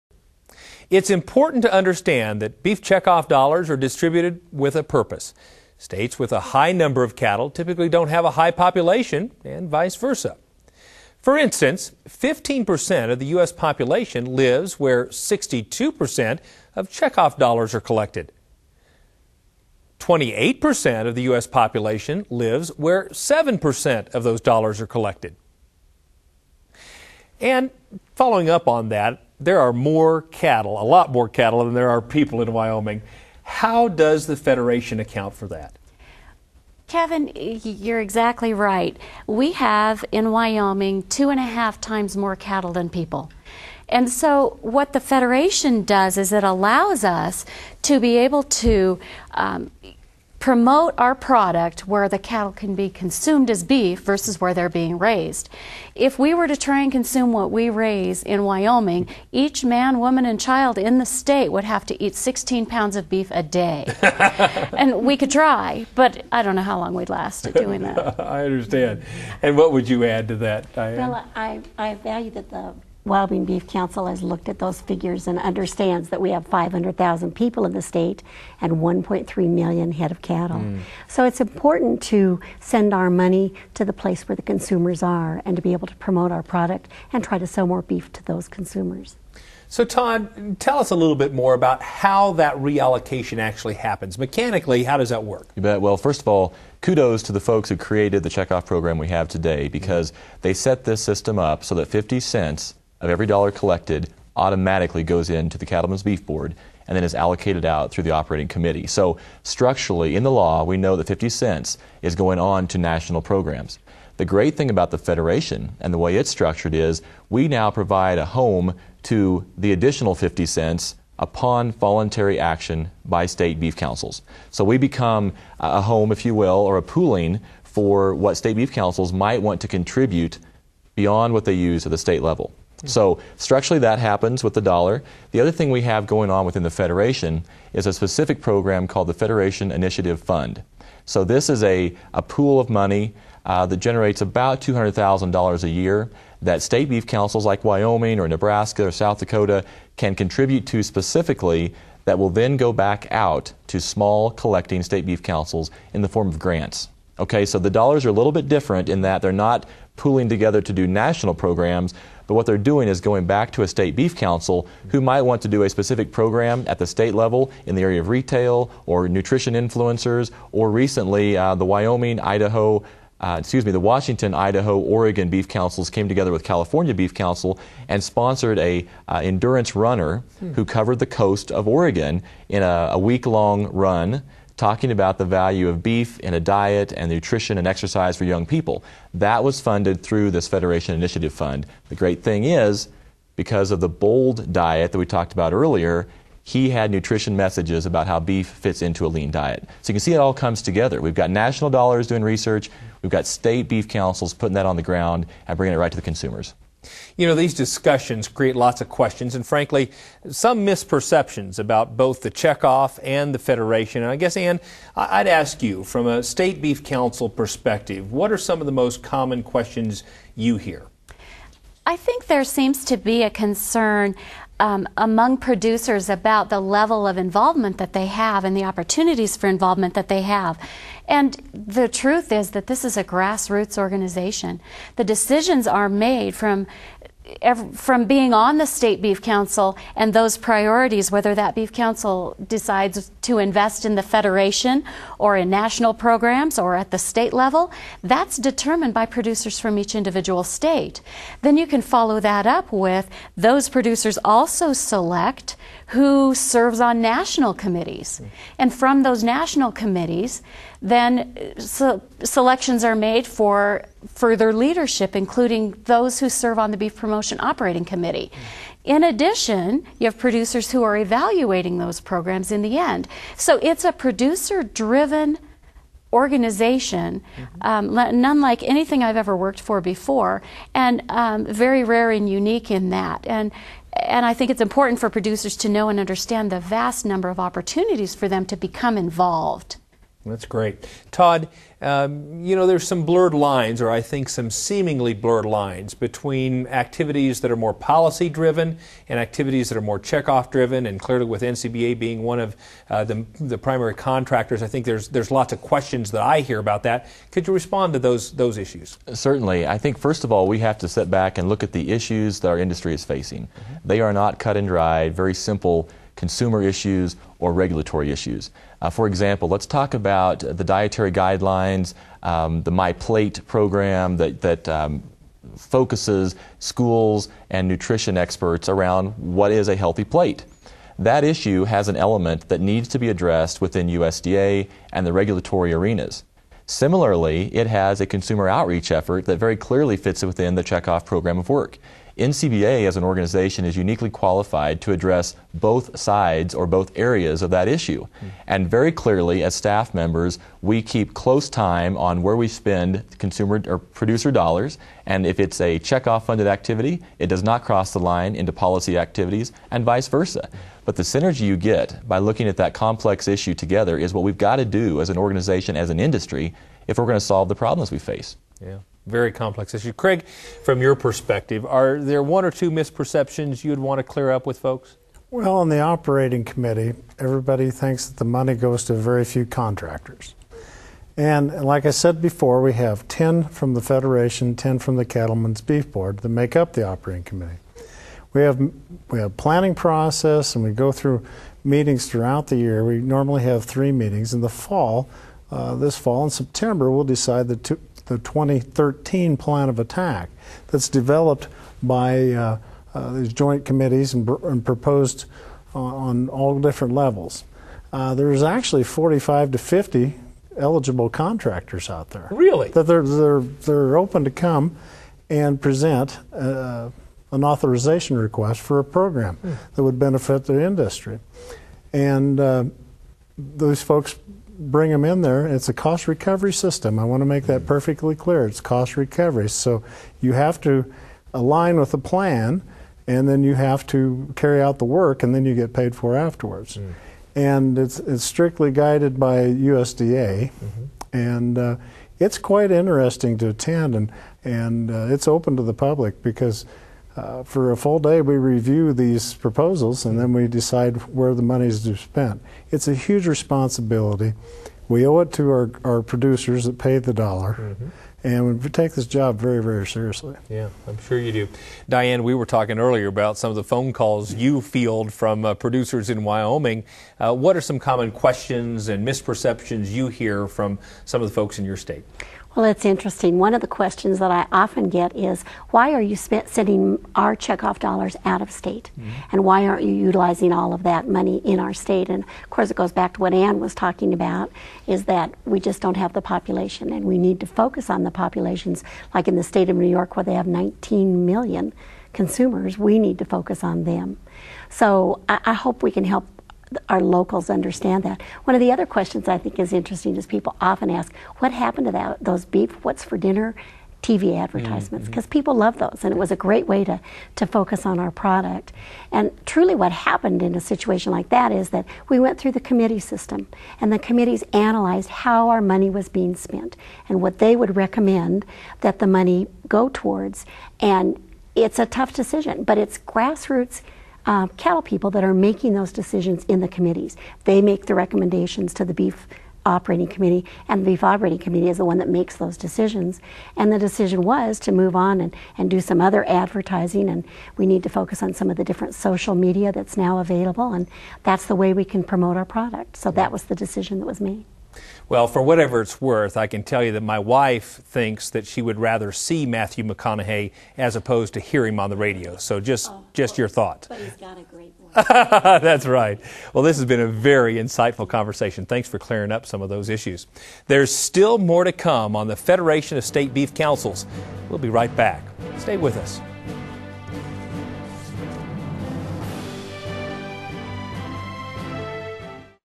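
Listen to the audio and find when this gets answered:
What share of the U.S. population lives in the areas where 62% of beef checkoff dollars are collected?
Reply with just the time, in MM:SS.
00:12.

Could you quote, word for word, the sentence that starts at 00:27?
And following up on that, there are more cattle, a lot more cattle than there are people in Wyoming.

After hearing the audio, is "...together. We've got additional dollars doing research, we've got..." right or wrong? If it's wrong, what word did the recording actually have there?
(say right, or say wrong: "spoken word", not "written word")
wrong: "national", not "additional".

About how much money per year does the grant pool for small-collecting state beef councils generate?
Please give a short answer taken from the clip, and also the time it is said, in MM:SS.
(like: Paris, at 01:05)
$200,000, at 02:24.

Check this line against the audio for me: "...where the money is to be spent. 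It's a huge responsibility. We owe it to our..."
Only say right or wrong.
right.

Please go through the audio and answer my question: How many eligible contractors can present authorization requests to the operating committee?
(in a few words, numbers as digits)
45 to 50.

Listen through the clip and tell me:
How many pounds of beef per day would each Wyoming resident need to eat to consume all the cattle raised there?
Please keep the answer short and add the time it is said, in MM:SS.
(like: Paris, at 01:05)
16 pounds, at 01:02.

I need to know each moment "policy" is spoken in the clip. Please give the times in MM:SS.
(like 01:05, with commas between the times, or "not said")
04:57, 05:58.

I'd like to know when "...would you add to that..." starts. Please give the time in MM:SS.
01:09.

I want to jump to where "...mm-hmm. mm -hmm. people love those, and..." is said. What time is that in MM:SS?
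08:25.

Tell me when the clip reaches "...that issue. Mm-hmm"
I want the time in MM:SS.
05:47.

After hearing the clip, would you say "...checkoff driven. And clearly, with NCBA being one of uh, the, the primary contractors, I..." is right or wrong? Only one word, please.
right.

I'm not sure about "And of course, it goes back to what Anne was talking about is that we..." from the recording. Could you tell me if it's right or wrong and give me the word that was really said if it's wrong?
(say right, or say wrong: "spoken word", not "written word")
right.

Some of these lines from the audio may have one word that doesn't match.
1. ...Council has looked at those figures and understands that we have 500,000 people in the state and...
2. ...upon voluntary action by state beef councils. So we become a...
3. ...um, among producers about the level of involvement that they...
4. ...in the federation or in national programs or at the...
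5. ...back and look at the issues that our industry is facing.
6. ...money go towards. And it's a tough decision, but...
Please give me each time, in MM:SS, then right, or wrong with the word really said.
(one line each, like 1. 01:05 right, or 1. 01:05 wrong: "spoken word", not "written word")
1. 01:13 right
2. 02:01 right
3. 03:44 right
4. 04:03 right
5. 05:11 right
6. 08:39 right.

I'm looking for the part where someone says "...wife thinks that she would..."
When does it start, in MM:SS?
09:07.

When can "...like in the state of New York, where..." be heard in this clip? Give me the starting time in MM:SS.
08:09.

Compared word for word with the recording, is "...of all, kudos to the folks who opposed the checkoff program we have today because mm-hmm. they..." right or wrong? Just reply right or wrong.
wrong.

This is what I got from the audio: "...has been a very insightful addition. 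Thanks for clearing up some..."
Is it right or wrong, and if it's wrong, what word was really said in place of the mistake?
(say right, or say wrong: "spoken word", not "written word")
wrong: "conversation", not "addition".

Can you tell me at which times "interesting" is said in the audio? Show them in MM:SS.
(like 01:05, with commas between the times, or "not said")
07:22, 07:52, 08:19.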